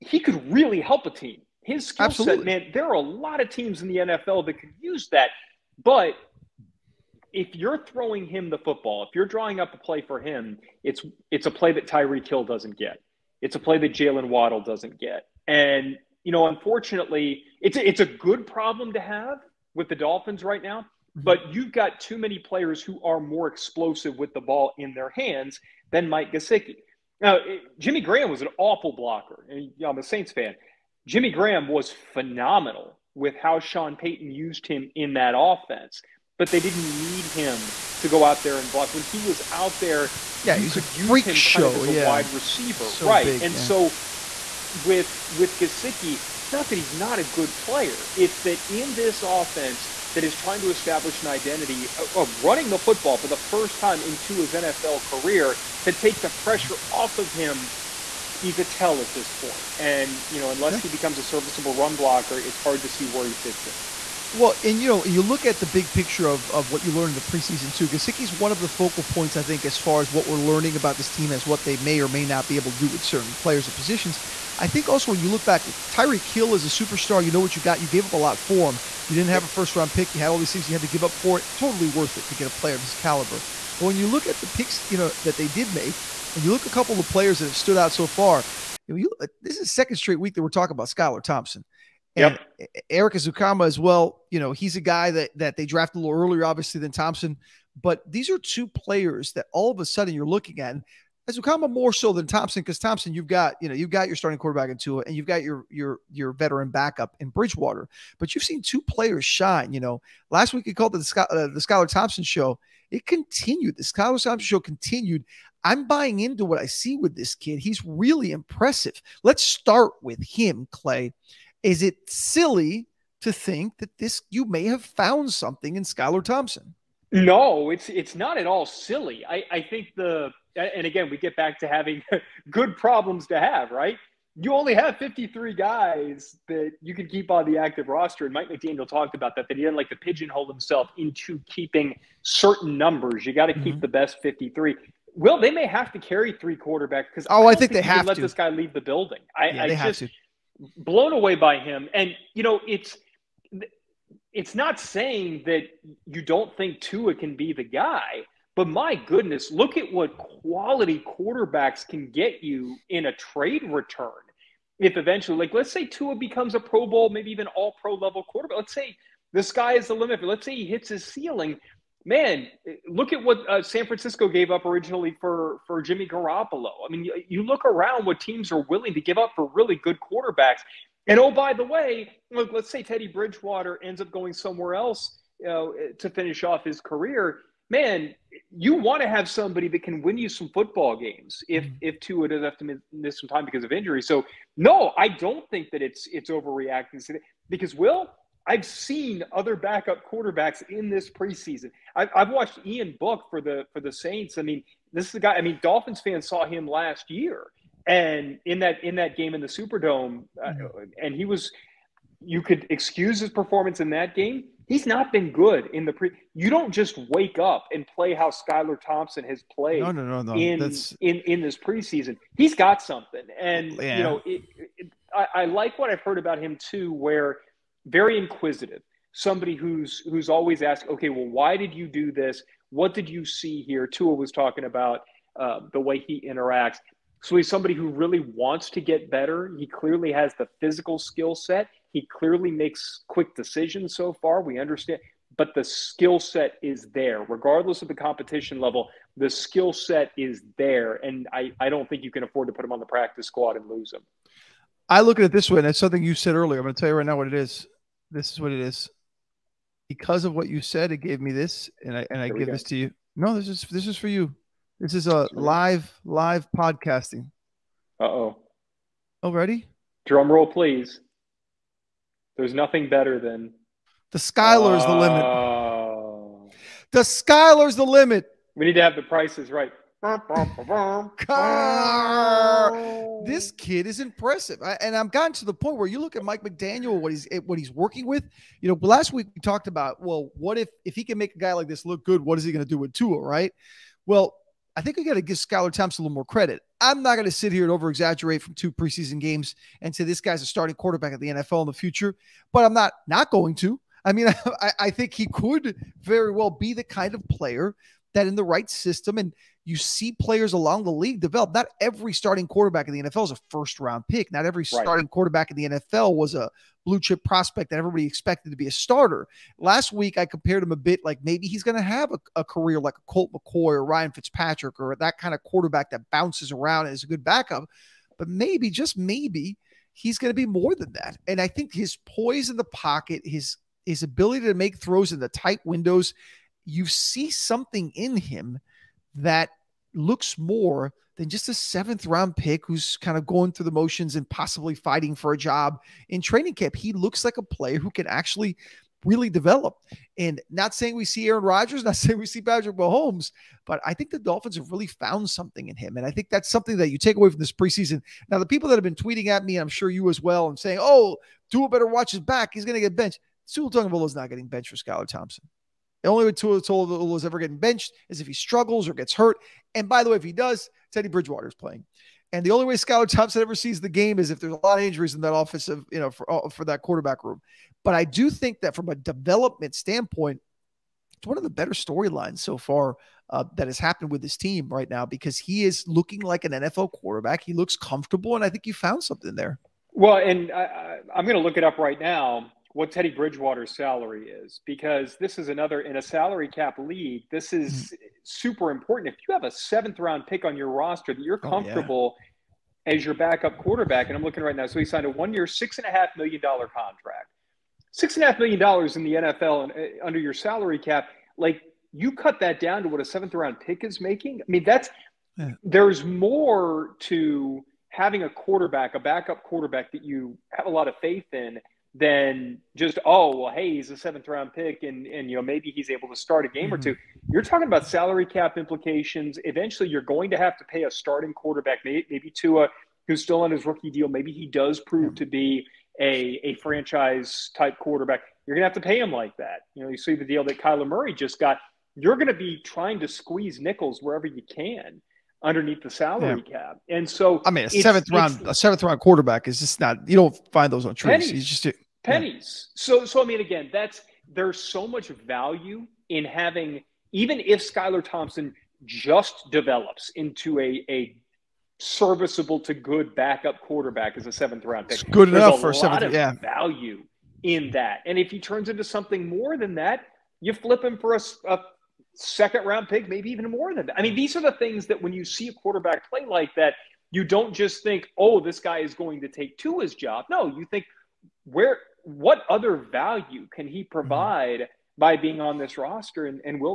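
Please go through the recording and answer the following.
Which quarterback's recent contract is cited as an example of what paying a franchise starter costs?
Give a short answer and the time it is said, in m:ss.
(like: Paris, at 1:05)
Kyler Murray, at 7:20.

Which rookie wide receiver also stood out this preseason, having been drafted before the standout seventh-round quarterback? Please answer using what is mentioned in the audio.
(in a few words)
Erik Ezukanma.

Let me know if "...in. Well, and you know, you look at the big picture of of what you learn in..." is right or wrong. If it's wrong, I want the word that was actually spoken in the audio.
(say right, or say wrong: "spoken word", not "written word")
right.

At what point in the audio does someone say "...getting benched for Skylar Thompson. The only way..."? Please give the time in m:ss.
6:04.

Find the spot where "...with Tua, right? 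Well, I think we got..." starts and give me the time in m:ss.
4:52.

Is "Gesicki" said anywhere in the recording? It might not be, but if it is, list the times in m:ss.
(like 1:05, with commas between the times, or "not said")
0:26, 0:45, 1:07.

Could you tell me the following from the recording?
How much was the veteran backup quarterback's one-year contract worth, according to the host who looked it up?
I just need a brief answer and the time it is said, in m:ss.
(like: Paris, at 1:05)
$6.5 million, at 6:45.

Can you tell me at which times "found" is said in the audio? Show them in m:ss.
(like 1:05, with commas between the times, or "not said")
2:04, 5:54, 6:28.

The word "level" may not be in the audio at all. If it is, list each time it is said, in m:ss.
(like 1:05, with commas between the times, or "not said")
2:47, 4:08.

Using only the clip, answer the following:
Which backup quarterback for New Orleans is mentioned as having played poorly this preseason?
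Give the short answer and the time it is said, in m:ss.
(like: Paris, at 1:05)
Ian Book, at 3:22.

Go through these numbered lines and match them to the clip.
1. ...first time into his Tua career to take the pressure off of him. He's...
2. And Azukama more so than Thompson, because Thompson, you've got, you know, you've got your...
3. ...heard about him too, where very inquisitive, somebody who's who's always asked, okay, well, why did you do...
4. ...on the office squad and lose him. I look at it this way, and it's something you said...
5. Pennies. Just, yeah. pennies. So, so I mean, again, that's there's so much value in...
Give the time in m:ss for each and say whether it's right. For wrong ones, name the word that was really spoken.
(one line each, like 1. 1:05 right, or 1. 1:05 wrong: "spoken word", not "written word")
1. 0:53 wrong: "NFL", not "Tua"
2. 1:40 right
3. 3:46 right
4. 4:12 wrong: "practice", not "office"
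5. 7:31 right.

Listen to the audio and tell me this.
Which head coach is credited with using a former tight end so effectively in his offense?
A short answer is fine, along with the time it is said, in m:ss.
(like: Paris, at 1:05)
Sean Payton, at 0:33.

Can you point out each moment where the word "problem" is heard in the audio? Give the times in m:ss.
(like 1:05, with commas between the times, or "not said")
0:18, 2:12.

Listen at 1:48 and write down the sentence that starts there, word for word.
But you've seen two players shine.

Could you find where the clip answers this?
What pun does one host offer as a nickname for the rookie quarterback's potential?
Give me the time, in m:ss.
4:36.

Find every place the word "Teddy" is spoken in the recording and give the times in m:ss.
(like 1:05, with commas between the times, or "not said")
3:02, 6:10, 6:32.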